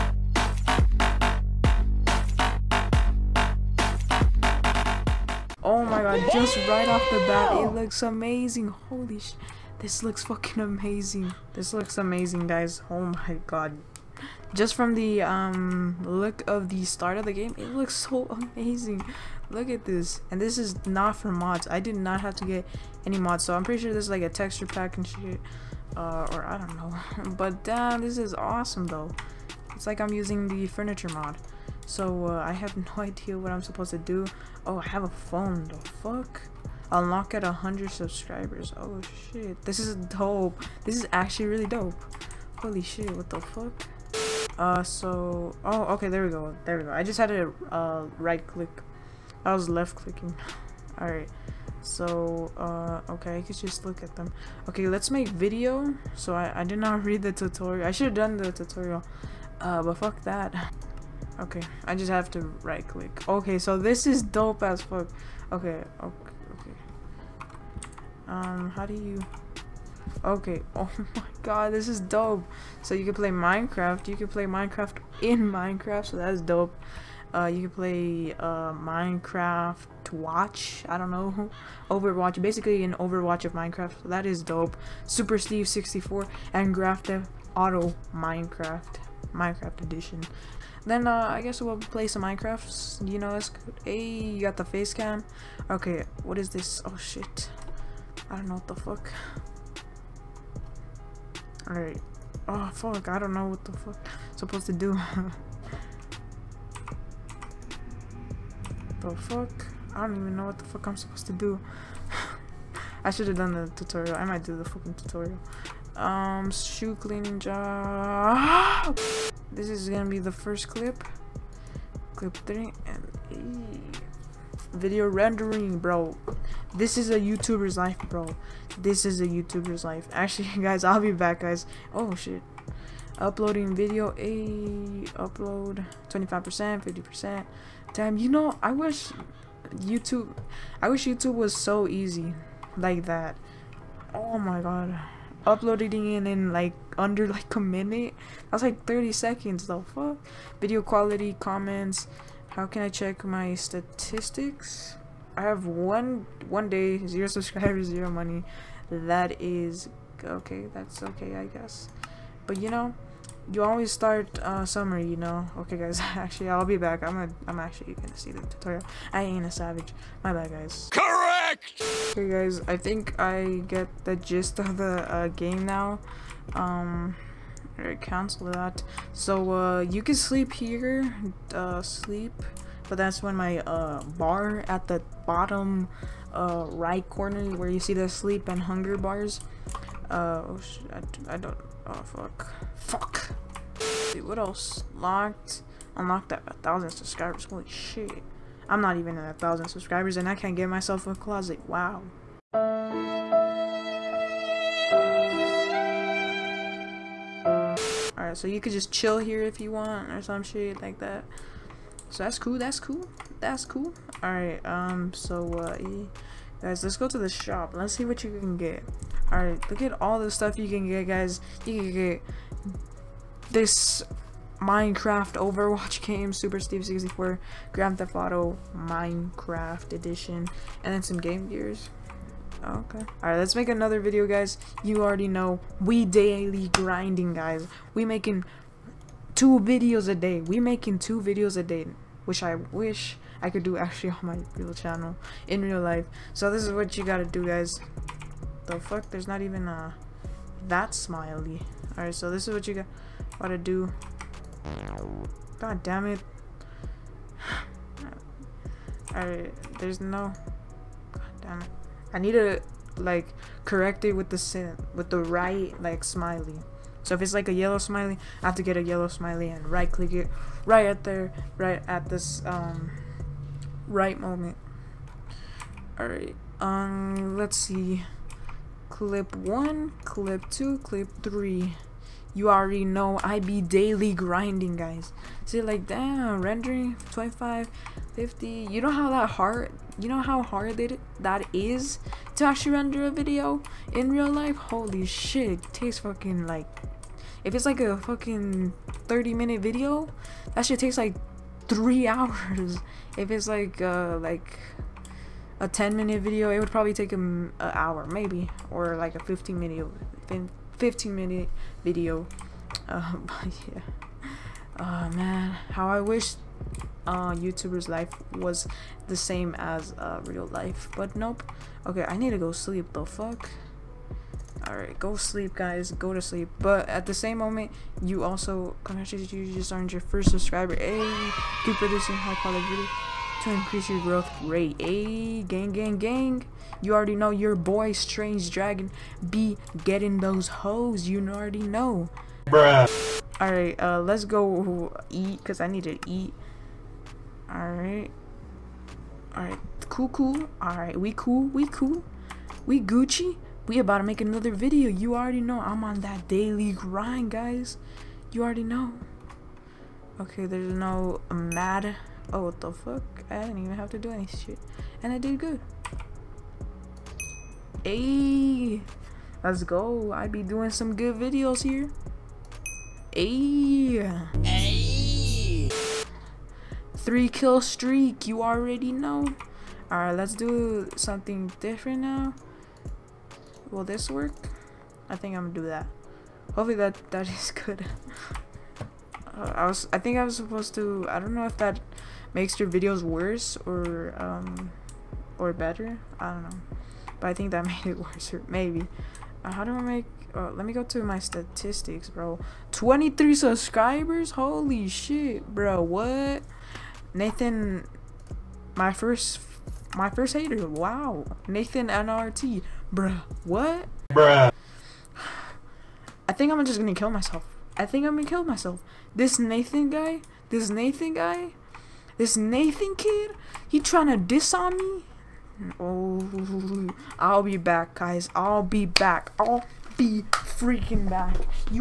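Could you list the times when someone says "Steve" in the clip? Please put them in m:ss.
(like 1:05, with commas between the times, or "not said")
1:25, 3:46.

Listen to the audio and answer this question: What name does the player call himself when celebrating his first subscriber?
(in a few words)
Strange Dragon.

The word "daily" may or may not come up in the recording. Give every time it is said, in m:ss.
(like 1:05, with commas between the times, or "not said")
3:56, 4:43, 5:56.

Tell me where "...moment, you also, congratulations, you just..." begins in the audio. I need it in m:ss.
5:27.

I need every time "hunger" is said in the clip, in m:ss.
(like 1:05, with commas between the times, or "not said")
3:08.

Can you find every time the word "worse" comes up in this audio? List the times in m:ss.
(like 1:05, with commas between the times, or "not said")
6:33, 6:37.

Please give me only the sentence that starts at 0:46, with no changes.
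I just had to uh, right click.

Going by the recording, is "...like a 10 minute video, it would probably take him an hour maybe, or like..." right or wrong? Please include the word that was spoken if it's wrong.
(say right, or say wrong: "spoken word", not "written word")
right.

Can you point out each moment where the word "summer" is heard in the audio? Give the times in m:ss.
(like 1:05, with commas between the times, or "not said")
2:44.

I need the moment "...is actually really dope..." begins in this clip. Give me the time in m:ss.
0:40.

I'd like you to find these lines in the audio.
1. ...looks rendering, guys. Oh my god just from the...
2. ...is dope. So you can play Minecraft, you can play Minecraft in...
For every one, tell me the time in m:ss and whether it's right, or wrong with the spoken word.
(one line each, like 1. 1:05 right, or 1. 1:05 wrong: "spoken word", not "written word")
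1. 0:11 wrong: "amazing", not "rendering"
2. 1:11 right.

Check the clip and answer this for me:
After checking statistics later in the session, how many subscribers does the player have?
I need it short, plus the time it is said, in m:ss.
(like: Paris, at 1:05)
23, at 6:42.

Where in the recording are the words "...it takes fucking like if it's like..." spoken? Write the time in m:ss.
4:55.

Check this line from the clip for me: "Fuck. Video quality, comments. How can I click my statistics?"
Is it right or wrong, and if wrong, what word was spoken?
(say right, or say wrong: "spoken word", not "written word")
wrong: "check", not "click".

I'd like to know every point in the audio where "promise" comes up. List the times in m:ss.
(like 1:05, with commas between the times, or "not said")
not said.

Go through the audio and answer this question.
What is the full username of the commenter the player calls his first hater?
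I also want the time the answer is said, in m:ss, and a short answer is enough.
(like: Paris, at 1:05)
Nathan NRT, at 6:51.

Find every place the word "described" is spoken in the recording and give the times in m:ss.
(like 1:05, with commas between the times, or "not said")
not said.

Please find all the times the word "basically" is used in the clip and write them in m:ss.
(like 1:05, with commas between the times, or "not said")
1:22.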